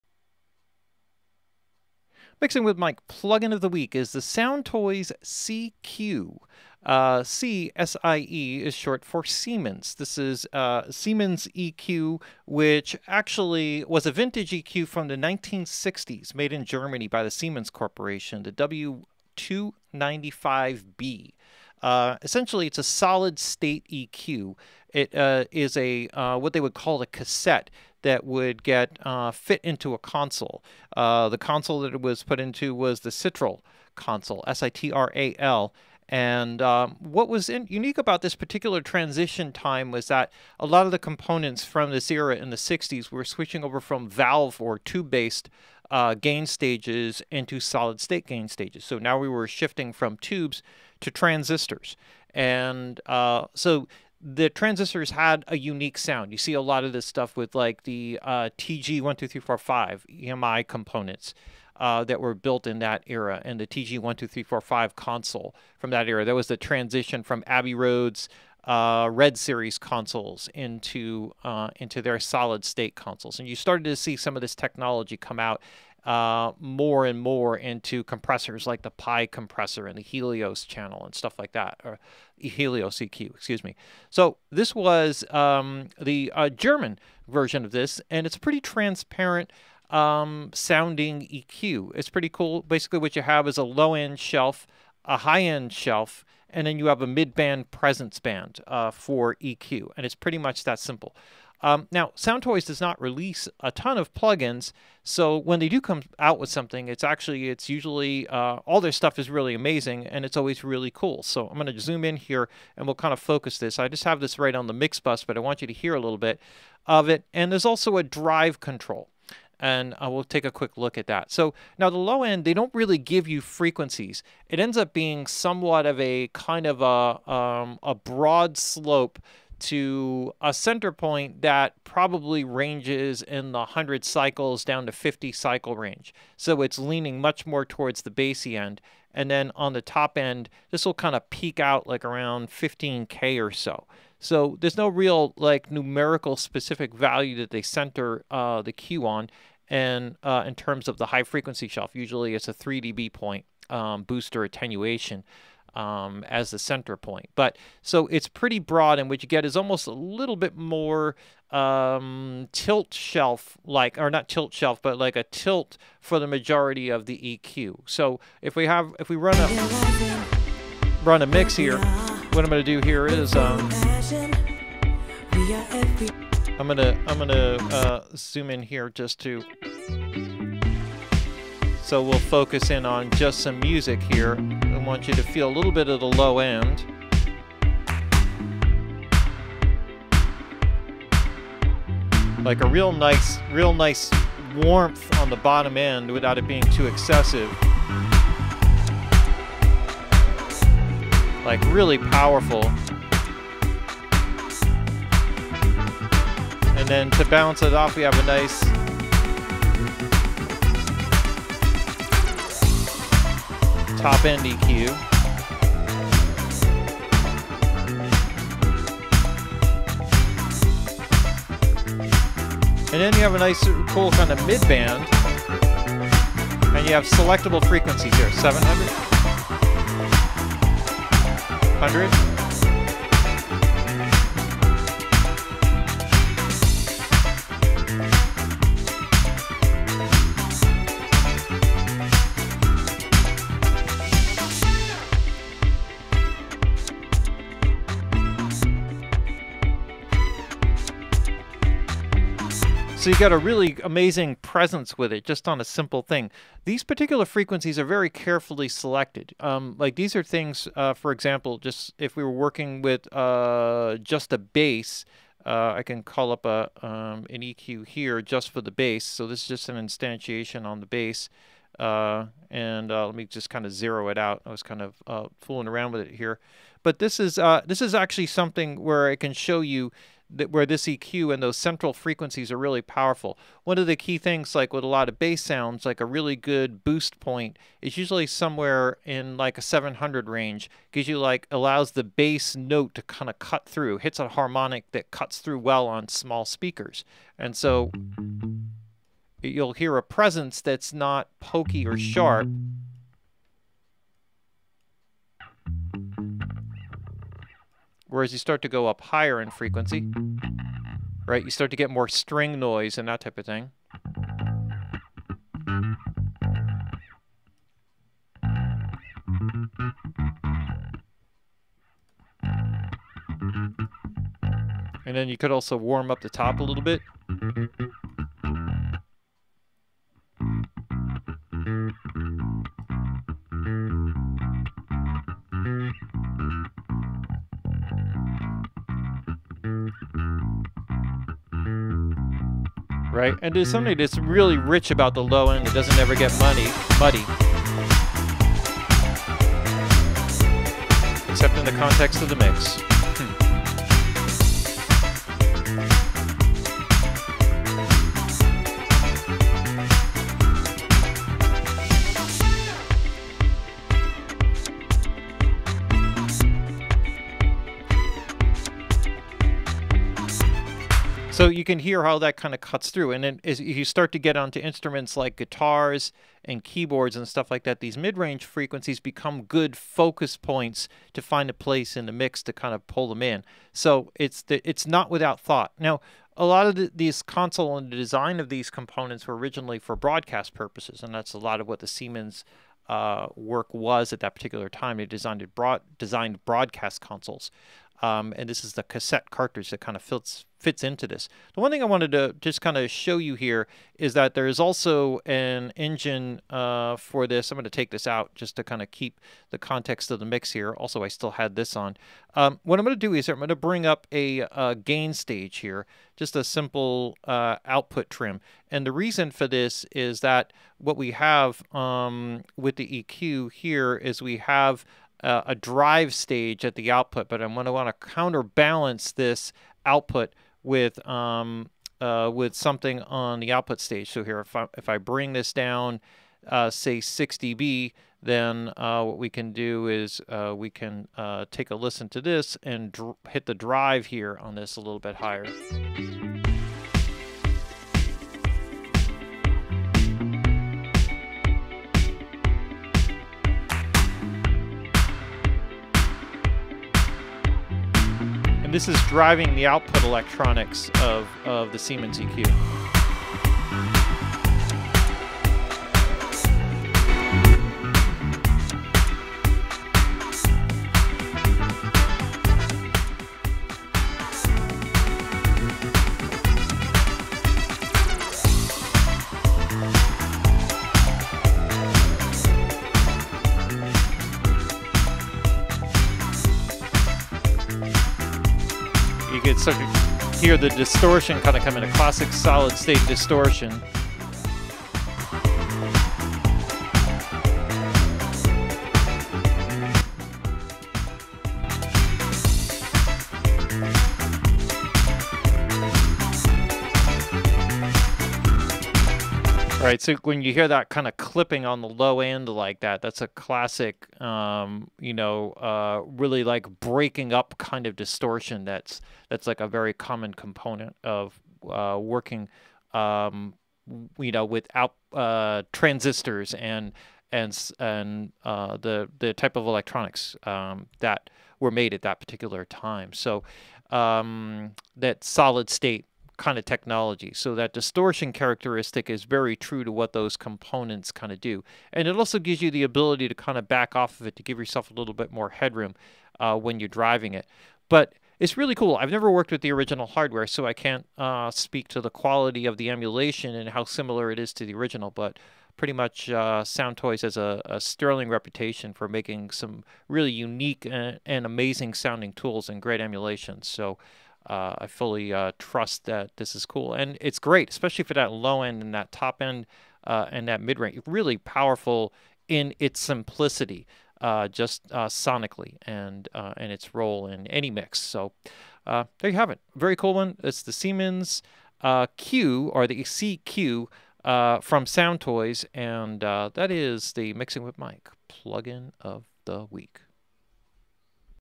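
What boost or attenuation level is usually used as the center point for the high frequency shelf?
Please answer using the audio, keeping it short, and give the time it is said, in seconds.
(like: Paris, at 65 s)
3 dB, at 152 s.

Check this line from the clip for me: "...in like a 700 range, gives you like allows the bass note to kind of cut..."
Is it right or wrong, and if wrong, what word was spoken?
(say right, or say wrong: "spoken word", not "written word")
right.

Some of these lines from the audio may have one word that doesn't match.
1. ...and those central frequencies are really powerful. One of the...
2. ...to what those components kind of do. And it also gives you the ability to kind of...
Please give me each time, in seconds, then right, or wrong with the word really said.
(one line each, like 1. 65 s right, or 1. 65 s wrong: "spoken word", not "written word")
1. 281 s right
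2. 539 s right.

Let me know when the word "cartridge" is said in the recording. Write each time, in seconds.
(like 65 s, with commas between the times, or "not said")
399 s.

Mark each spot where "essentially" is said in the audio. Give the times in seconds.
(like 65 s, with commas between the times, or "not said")
22 s.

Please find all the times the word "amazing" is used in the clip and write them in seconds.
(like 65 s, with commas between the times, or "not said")
109 s, 253 s, 561 s.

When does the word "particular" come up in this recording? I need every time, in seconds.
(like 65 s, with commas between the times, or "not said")
38 s, 256 s, 394 s, 532 s.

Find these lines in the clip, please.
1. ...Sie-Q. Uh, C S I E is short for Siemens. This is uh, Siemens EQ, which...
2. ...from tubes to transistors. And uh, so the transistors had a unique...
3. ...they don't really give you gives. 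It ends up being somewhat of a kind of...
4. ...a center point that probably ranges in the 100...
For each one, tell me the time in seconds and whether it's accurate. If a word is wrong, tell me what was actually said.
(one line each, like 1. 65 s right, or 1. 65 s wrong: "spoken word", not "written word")
1. 5 s right
2. 49 s right
3. 122 s wrong: "frequencies", not "gives"
4. 130 s right.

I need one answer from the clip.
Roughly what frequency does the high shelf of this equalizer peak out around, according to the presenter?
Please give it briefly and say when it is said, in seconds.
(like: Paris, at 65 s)
15K, at 142 s.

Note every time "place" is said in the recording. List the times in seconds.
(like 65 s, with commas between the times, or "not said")
381 s.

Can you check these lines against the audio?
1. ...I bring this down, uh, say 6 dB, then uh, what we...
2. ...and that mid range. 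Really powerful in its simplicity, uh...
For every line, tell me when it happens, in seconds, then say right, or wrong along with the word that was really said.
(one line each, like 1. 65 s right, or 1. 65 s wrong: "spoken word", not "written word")
1. 434 s right
2. 570 s right.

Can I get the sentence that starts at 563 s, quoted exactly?
So uh, I fully uh, trust that this is cool.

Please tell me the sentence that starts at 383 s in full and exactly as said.
So it's the, it's not without thought.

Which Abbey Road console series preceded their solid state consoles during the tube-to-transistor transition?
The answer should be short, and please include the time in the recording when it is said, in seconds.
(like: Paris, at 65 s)
REDD Series, at 69 s.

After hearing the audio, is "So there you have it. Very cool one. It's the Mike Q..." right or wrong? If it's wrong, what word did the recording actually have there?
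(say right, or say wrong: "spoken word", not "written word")
wrong: "Siemens", not "Mike".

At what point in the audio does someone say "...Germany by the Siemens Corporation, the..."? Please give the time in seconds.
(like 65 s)
16 s.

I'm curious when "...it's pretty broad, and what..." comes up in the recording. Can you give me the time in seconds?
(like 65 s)
158 s.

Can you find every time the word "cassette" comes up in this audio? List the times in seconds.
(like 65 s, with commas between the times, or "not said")
27 s, 398 s.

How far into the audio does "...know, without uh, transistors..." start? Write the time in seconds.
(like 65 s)
524 s.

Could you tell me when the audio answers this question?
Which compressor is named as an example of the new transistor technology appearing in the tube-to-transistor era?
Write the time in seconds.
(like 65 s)
78 s.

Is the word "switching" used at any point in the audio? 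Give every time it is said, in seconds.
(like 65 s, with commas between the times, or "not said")
43 s.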